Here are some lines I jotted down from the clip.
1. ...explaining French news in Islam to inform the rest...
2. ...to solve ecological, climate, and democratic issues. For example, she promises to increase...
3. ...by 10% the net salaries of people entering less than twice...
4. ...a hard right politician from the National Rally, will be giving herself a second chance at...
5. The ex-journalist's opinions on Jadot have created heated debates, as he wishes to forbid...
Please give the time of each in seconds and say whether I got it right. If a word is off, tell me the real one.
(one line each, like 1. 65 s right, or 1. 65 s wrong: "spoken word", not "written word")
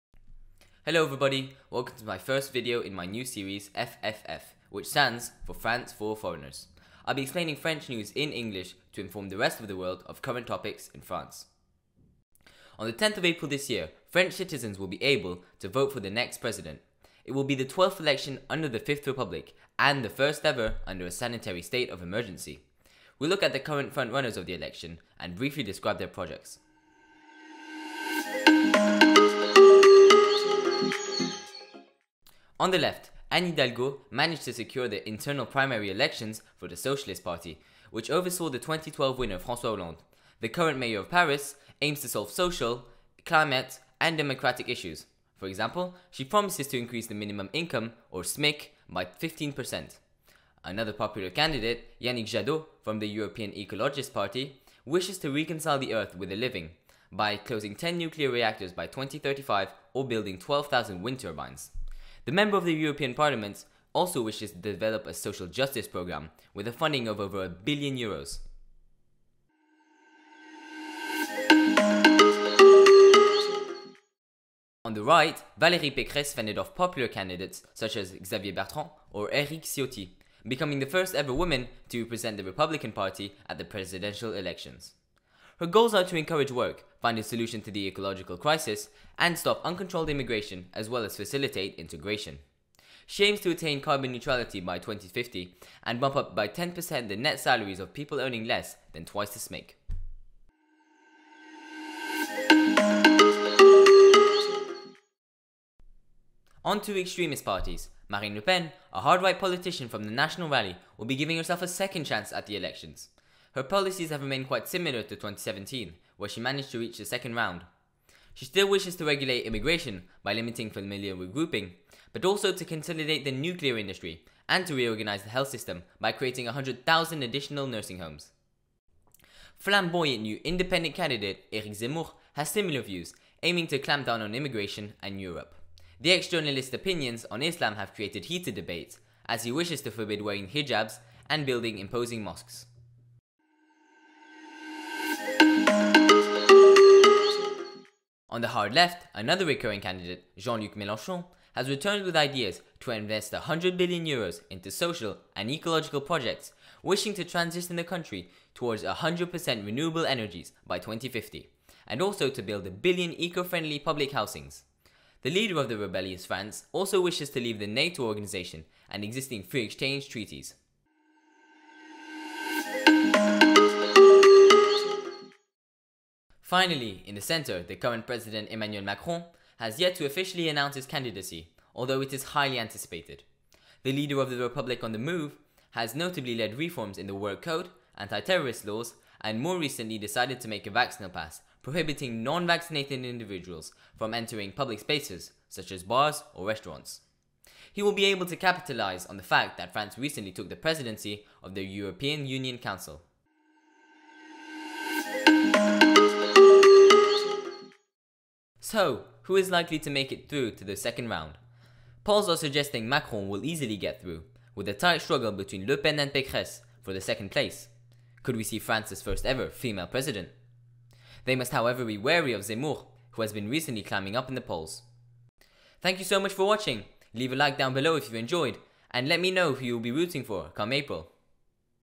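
1. 7 s wrong: "English", not "Islam"
2. 42 s wrong: "social", not "ecological"
3. 96 s wrong: "earning", not "entering"
4. 108 s right
5. 135 s wrong: "Islam", not "Jadot".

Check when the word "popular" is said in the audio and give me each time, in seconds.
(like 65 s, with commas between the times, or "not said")
50 s, 76 s.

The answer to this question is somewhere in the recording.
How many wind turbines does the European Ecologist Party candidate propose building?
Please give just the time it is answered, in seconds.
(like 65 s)
60 s.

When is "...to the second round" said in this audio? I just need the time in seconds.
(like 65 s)
210 s.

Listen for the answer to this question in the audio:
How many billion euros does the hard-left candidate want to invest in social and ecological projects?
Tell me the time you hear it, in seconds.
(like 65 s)
153 s.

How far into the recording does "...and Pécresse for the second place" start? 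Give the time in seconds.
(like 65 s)
215 s.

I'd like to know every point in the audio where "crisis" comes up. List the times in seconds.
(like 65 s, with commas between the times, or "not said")
88 s.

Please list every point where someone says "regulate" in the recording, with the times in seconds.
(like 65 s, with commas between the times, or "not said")
119 s.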